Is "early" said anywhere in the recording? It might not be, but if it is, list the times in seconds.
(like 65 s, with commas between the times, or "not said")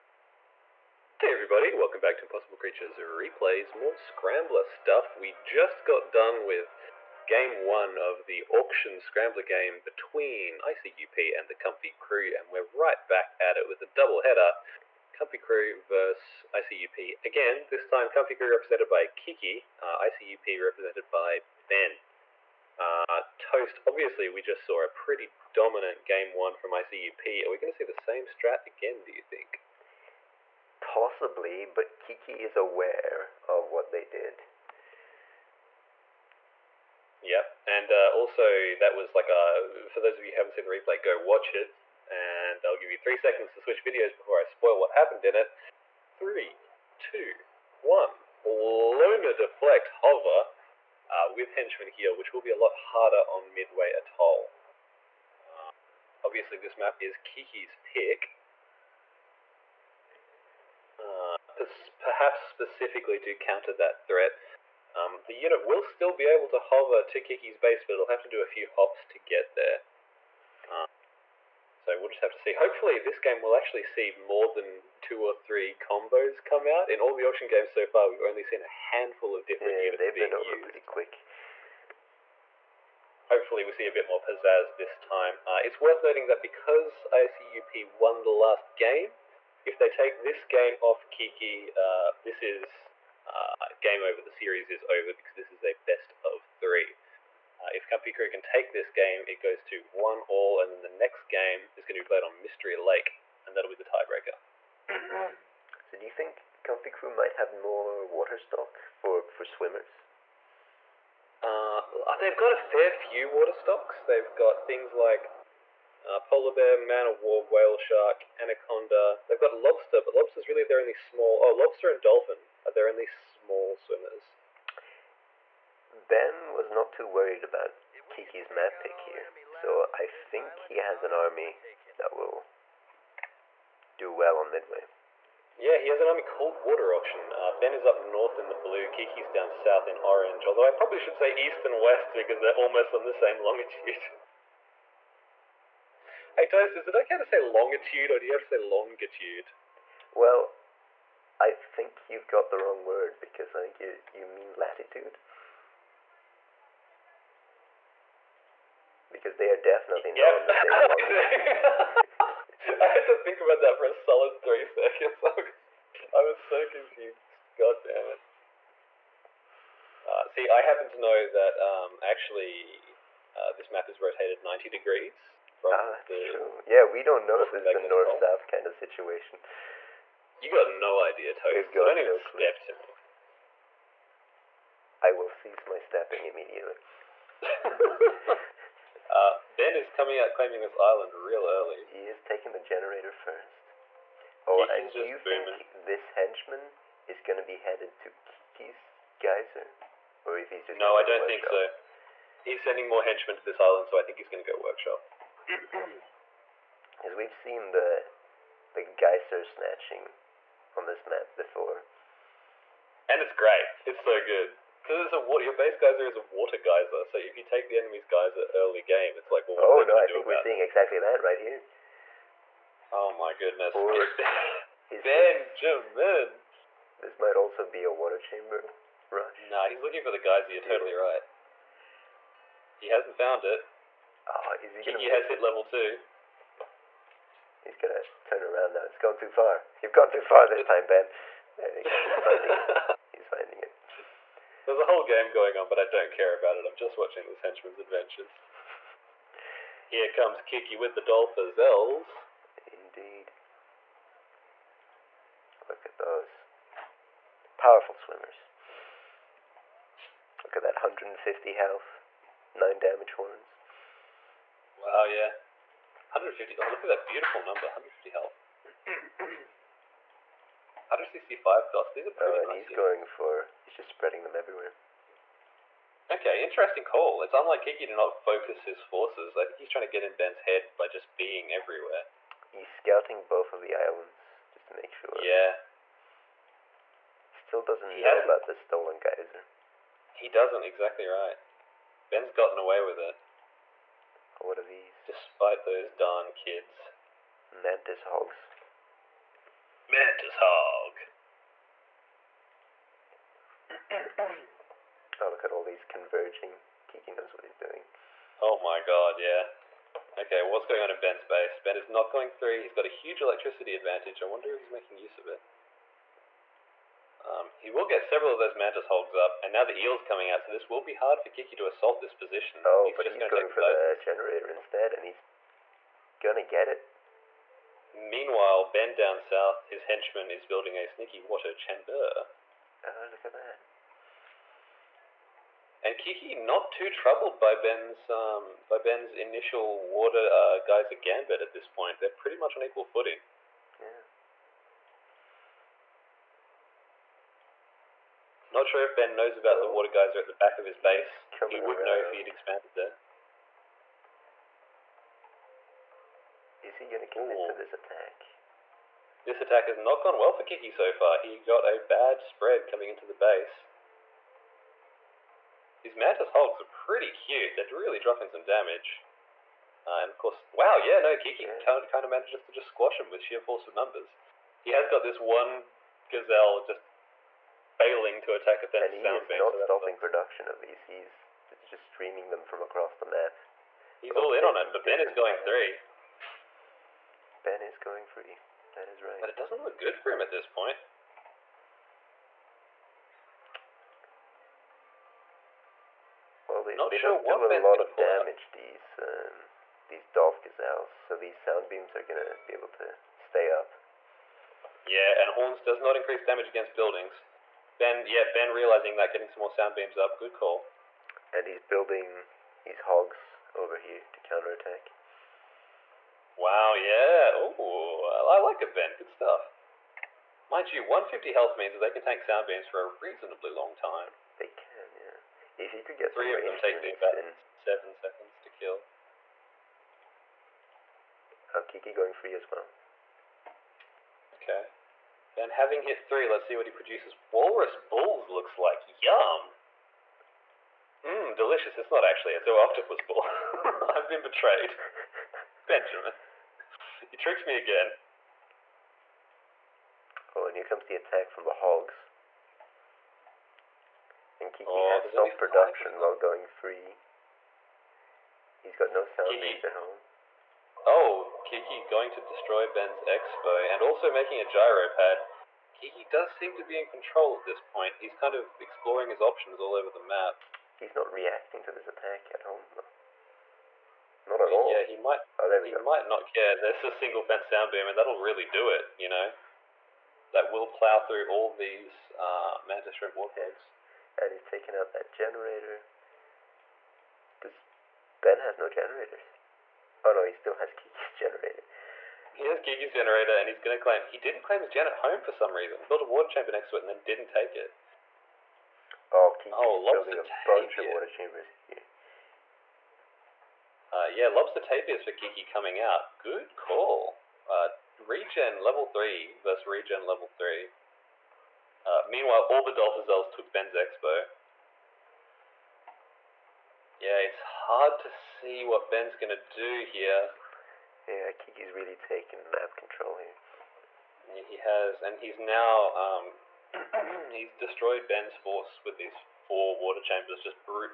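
191 s, 218 s.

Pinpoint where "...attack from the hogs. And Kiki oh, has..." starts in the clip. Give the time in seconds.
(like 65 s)
450 s.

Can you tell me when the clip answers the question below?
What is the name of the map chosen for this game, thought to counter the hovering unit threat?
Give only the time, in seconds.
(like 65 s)
53 s.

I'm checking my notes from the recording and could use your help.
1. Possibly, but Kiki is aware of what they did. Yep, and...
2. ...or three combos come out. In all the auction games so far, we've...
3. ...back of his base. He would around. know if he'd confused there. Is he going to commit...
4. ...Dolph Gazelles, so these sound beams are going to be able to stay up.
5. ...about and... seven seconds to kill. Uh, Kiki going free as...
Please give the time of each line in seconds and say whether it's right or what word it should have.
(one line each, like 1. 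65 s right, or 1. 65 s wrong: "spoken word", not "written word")
1. 30 s right
2. 75 s right
3. 350 s wrong: "expanded", not "confused"
4. 400 s right
5. 426 s right.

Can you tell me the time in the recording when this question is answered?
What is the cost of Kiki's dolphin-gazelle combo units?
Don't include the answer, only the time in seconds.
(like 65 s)
268 s.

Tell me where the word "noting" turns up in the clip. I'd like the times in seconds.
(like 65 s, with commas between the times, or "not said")
86 s.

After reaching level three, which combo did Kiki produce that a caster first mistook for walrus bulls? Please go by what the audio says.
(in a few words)
Octopus bull.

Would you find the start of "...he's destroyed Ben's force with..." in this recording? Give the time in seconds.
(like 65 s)
527 s.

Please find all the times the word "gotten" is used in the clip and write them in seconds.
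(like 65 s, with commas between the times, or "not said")
292 s.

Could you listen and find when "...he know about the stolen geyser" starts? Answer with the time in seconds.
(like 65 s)
287 s.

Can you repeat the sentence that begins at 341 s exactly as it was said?
They're pretty much on equal footing.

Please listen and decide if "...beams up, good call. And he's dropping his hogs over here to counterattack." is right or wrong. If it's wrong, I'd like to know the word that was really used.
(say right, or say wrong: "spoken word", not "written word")
wrong: "building", not "dropping".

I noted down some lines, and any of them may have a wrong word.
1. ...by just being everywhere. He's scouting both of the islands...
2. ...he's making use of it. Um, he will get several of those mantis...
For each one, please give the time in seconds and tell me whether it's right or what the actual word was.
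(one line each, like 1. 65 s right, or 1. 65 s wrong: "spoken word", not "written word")
1. 280 s right
2. 314 s right.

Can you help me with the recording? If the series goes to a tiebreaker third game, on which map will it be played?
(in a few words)
Mystery Lake.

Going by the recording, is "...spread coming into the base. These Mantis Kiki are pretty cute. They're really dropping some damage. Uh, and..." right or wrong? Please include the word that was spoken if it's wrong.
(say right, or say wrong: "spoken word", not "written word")
wrong: "Hogs", not "Kiki".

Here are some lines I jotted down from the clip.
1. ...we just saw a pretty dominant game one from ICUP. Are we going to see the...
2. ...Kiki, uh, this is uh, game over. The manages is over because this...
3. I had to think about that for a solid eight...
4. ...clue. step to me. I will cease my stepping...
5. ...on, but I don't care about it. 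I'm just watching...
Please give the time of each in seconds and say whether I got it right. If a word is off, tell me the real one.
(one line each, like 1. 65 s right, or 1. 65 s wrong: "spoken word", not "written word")
1. 24 s right
2. 91 s wrong: "series", not "manages"
3. 162 s wrong: "three", not "eight"
4. 182 s right
5. 245 s right.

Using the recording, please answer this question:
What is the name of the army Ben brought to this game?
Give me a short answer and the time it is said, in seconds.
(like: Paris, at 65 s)
Water Auction, at 136 s.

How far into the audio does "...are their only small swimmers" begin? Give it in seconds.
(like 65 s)
122 s.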